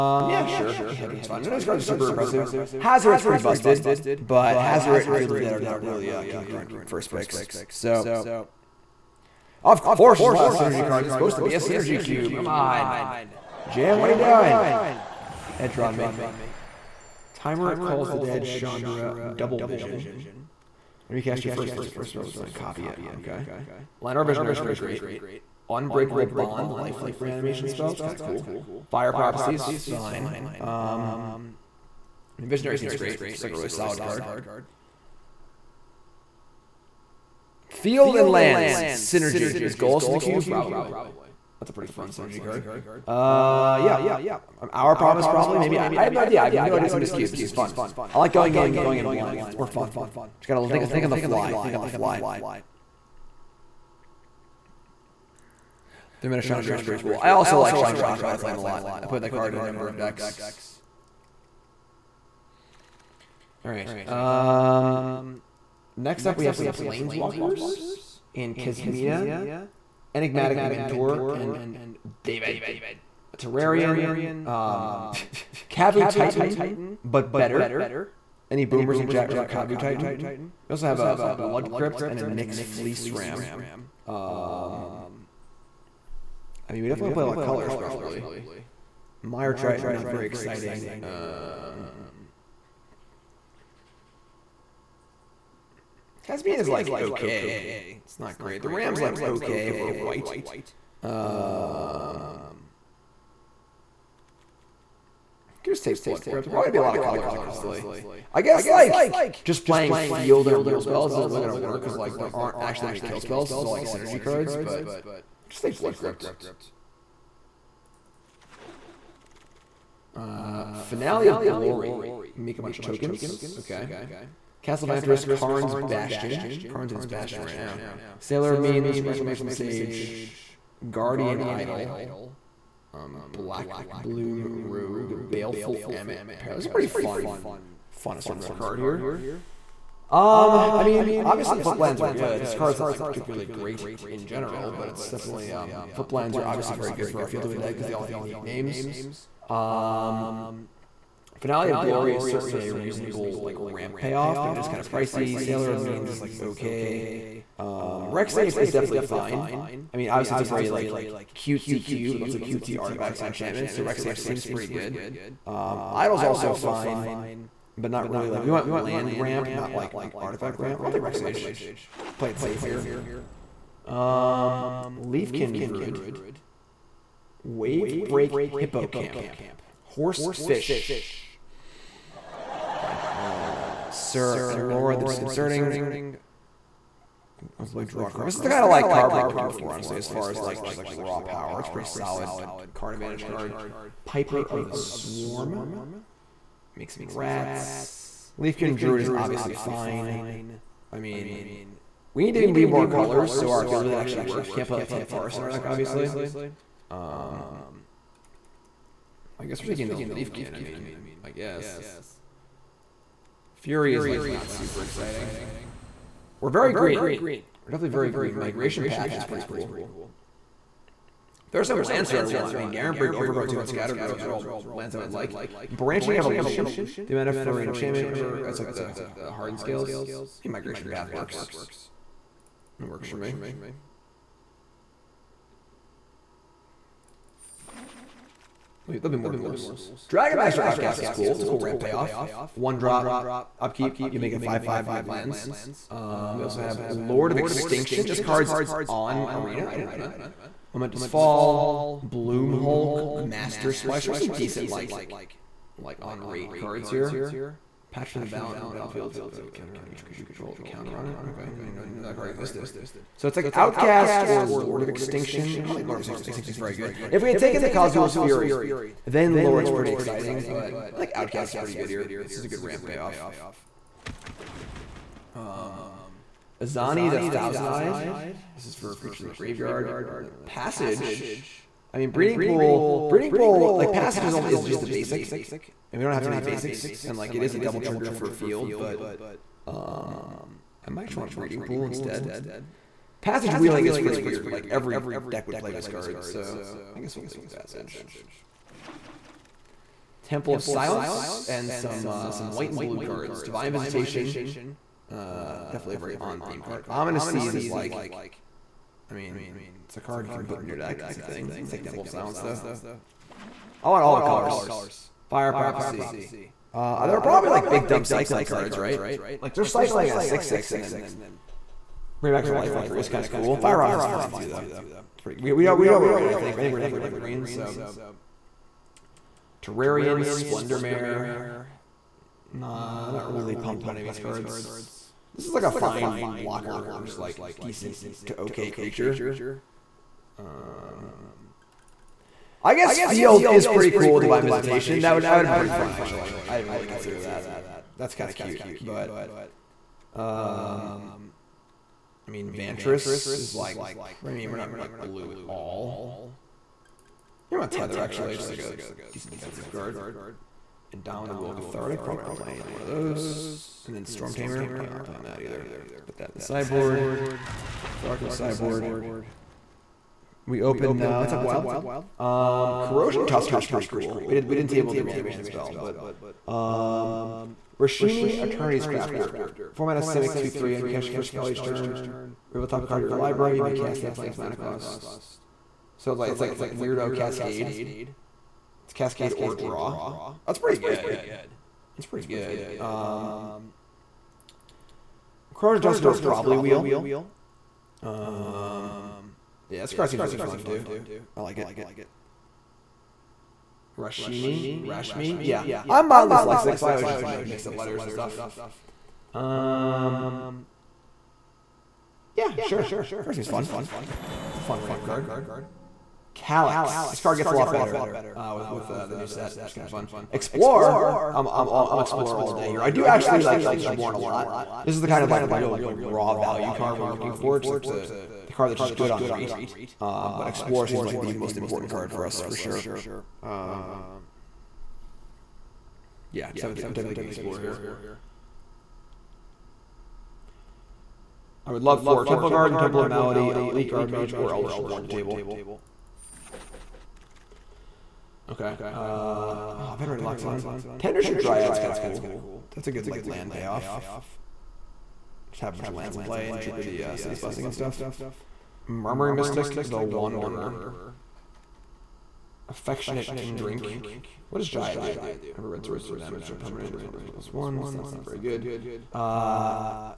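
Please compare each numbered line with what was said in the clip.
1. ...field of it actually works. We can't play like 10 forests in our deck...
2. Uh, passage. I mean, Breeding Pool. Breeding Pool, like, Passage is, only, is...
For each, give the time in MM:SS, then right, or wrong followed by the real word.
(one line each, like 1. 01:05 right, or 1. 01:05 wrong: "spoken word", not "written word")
1. 03:23 right
2. 04:40 right.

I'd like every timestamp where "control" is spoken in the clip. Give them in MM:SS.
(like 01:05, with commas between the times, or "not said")
04:20.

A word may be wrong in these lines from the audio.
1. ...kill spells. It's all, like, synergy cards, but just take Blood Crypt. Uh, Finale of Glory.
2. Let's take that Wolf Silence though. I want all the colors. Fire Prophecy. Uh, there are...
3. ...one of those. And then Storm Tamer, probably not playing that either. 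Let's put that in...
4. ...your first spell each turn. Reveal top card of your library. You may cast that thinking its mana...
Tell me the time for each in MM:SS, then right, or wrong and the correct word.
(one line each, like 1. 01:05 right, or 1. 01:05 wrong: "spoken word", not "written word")
1. 01:53 right
2. 05:11 right
3. 06:02 right
4. 06:21 wrong: "playing", not "thinking".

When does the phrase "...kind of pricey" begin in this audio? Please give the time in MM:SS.
02:34.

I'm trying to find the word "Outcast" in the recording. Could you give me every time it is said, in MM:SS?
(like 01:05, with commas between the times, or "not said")
04:00, 04:23, 04:31.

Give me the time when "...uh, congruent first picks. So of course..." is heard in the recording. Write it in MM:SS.
00:06.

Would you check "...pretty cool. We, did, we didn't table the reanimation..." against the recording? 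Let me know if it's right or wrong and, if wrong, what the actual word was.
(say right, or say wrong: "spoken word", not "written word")
right.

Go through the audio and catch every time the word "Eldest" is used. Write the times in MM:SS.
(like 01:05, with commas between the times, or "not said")
07:03, 07:24.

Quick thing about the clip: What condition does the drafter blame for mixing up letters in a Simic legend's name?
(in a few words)
Mildly dyslexic.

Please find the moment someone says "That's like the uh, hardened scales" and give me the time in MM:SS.
03:48.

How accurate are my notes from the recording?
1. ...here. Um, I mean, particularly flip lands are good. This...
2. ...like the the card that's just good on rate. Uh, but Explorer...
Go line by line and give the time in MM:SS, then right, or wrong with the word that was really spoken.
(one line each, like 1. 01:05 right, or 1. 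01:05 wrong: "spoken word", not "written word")
1. 02:18 wrong: "obviously", not "particularly"
2. 07:07 right.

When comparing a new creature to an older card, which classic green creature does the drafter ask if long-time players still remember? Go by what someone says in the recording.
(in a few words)
Kavu Titan.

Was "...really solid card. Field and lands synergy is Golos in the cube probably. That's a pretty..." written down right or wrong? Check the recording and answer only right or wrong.
right.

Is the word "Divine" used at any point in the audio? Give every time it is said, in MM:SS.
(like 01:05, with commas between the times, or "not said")
05:03, 05:44.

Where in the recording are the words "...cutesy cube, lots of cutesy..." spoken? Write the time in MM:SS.
02:41.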